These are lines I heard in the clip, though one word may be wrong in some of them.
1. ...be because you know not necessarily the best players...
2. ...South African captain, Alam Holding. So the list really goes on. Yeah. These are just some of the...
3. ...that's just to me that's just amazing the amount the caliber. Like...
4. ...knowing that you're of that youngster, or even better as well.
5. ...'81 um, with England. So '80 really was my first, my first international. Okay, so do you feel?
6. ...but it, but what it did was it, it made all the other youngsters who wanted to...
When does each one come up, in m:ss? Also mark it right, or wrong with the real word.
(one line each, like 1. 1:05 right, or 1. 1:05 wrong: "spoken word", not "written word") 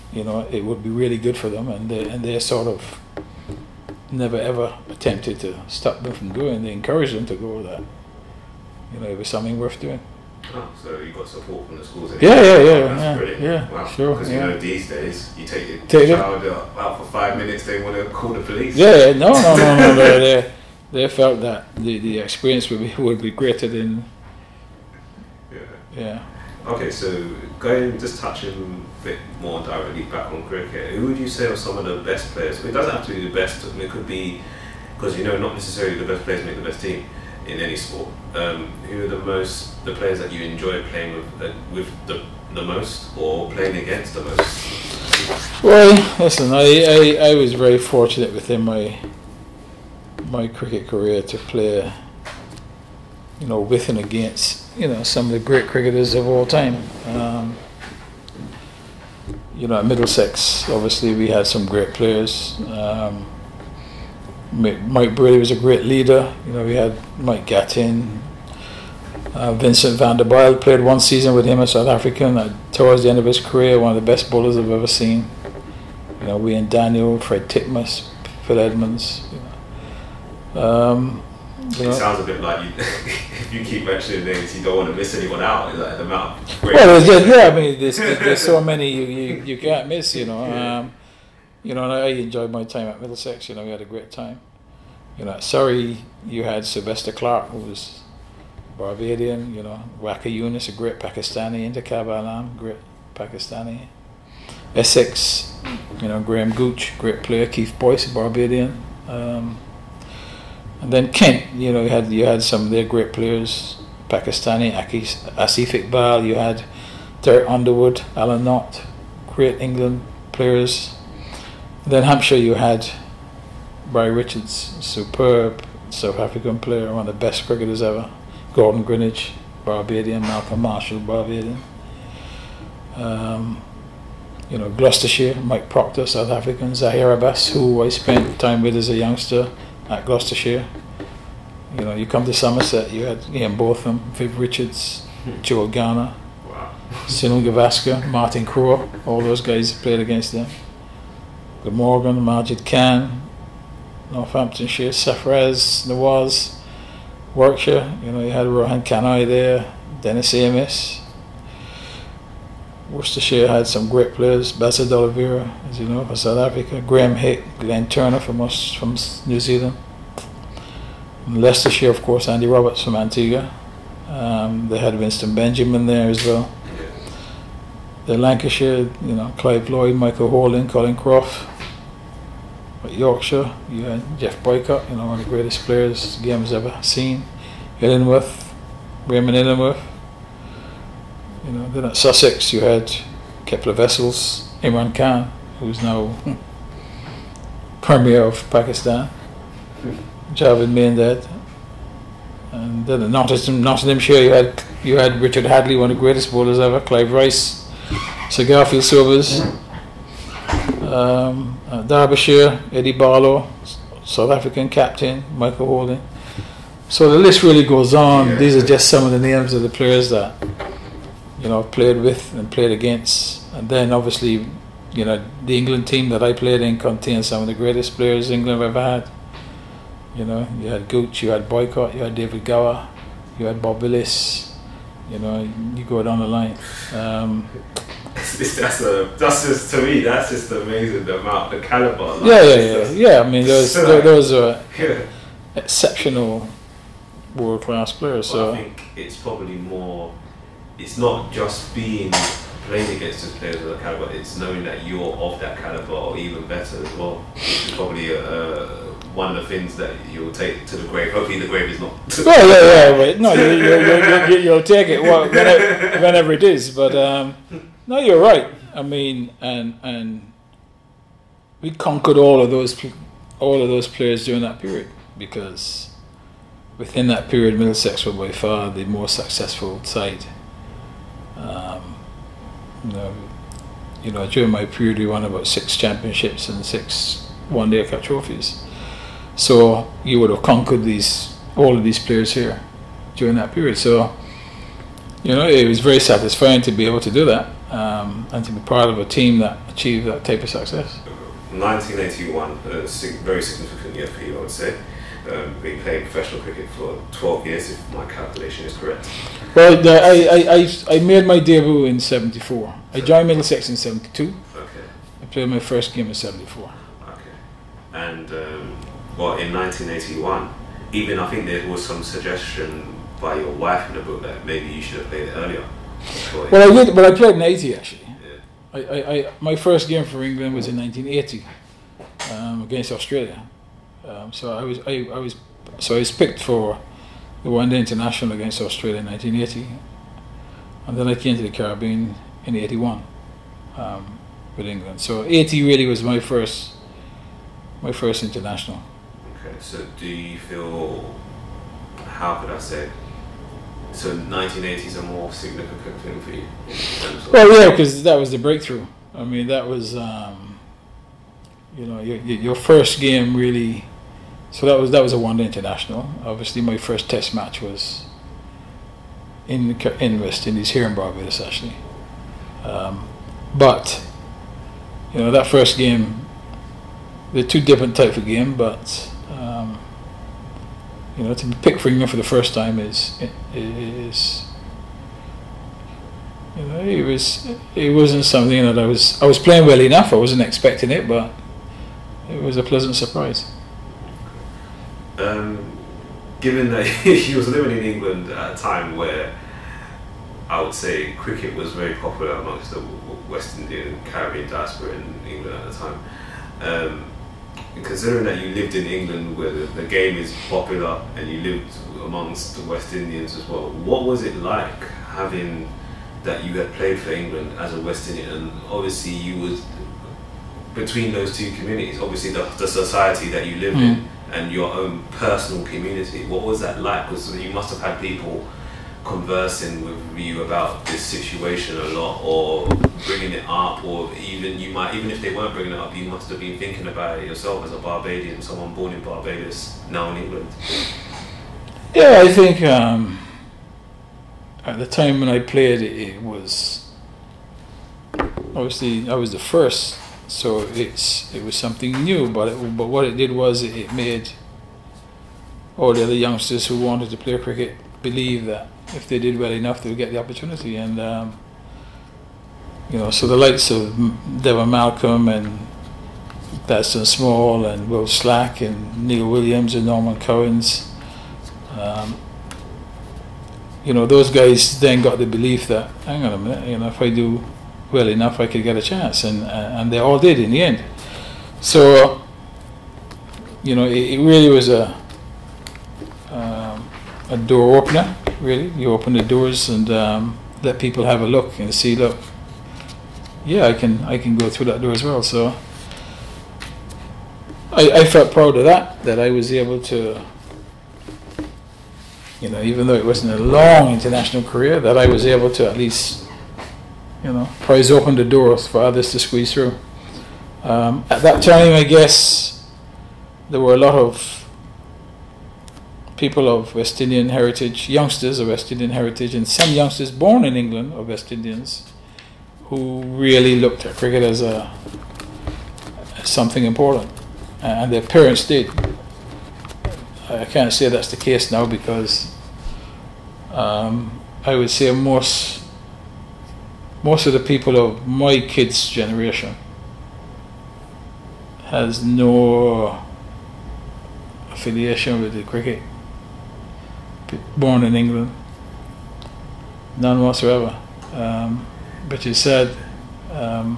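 1. 0:34 right
2. 3:34 wrong: "Michael", not "Alam"
3. 3:59 right
4. 4:14 wrong: "caliber", not "youngster"
5. 5:42 right
6. 7:32 right.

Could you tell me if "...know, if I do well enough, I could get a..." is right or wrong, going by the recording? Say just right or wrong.
right.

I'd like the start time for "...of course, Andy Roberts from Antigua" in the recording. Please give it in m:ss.
2:51.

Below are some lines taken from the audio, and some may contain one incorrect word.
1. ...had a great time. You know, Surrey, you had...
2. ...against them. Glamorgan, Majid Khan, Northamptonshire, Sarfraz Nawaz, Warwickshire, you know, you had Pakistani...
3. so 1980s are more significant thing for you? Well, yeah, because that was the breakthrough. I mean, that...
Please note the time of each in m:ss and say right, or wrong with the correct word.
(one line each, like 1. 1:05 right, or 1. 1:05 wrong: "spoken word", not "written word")
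1. 1:33 right
2. 2:29 wrong: "Rohan", not "Pakistani"
3. 5:53 right.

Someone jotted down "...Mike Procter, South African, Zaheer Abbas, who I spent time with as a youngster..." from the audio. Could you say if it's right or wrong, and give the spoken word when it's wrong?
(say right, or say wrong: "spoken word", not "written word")
right.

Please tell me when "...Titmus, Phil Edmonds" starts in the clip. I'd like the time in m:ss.
1:17.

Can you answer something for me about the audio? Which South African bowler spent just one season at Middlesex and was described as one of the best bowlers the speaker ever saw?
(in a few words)
Vincent van der Bijl.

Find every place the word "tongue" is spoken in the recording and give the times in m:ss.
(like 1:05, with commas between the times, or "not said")
not said.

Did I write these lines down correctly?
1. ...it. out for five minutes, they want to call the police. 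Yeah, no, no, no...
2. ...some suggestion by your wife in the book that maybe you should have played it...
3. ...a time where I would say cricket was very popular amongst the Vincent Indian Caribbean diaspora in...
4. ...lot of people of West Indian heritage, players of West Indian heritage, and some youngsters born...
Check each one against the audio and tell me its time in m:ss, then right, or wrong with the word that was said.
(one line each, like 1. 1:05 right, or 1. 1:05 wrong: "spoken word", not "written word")
1. 0:16 right
2. 5:21 right
3. 6:38 wrong: "West", not "Vincent"
4. 8:33 wrong: "youngsters", not "players".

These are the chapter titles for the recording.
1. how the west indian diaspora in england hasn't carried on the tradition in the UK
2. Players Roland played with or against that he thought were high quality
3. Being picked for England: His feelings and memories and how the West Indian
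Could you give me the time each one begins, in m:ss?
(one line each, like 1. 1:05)
1. 8:27
2. 0:40
3. 5:07.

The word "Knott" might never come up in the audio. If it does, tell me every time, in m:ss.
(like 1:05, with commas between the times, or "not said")
1:58.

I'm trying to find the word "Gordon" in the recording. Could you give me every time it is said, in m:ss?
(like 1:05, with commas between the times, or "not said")
2:08.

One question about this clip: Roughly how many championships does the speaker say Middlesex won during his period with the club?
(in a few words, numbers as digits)
6.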